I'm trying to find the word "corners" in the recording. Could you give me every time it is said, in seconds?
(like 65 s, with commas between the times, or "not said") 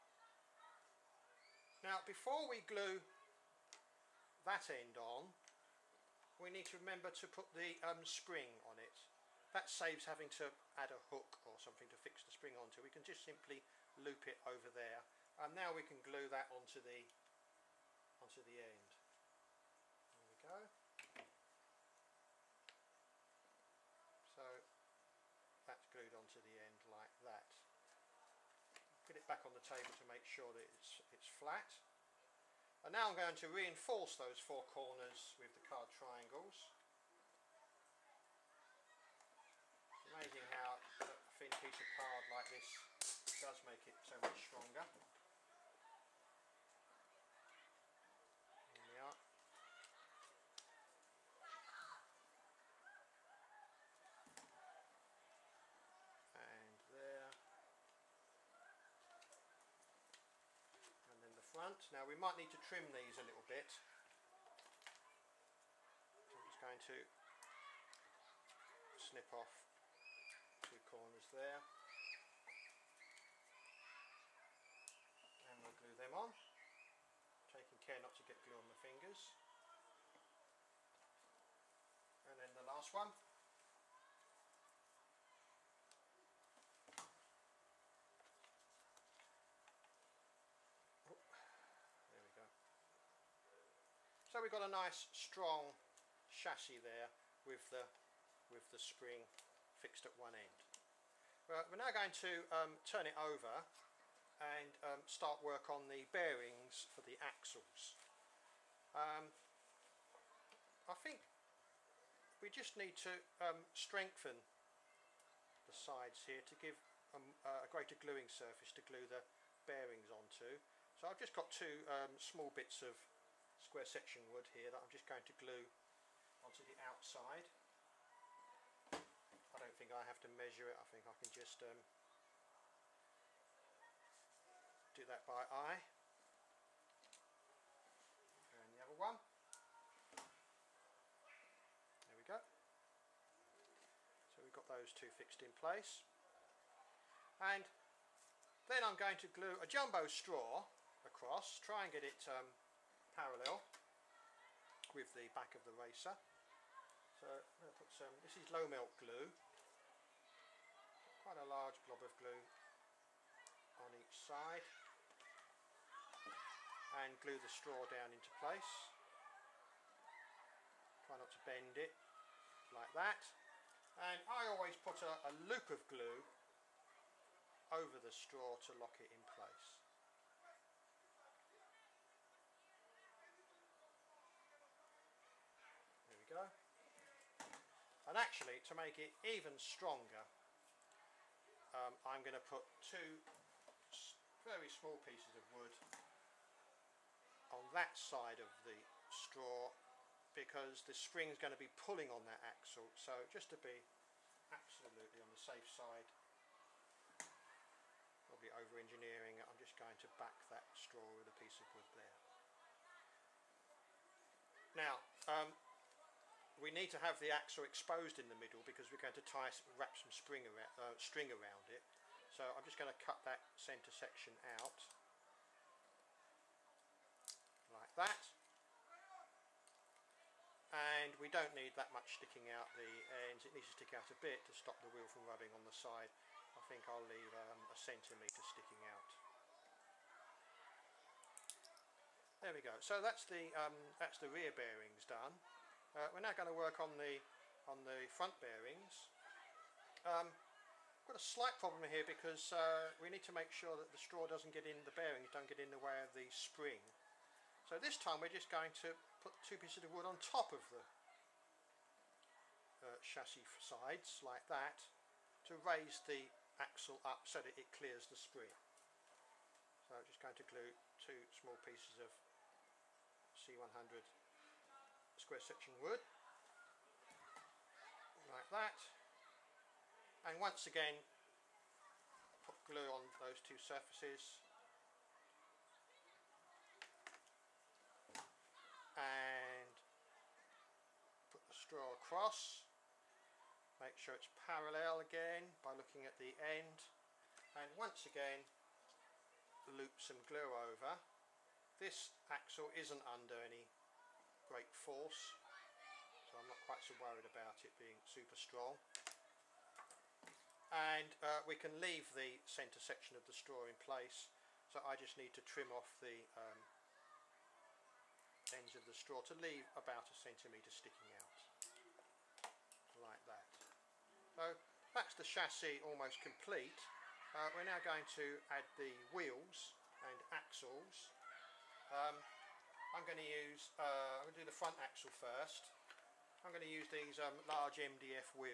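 34 s, 70 s.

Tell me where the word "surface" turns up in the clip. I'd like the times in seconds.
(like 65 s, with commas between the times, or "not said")
118 s, 283 s.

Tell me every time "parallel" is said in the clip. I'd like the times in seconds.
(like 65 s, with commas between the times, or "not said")
153 s, 294 s.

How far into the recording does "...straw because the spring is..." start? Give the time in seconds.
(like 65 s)
199 s.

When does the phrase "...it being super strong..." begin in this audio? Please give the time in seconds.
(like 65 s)
307 s.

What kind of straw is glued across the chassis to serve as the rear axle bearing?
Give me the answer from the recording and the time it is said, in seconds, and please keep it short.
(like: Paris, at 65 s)
jumbo straw, at 149 s.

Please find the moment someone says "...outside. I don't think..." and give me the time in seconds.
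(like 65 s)
126 s.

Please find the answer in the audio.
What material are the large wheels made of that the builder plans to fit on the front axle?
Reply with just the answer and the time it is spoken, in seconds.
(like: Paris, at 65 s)
MDF, at 337 s.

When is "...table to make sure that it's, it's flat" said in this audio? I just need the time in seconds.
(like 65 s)
29 s.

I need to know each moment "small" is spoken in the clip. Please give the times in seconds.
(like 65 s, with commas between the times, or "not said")
122 s, 194 s, 271 s.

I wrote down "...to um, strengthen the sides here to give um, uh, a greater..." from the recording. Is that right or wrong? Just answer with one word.
right.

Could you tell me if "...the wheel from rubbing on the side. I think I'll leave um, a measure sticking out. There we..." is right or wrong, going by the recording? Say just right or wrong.
wrong.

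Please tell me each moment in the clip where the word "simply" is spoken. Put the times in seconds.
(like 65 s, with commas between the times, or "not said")
13 s.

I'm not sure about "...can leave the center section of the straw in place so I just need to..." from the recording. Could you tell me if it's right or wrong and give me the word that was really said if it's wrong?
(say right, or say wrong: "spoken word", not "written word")
right.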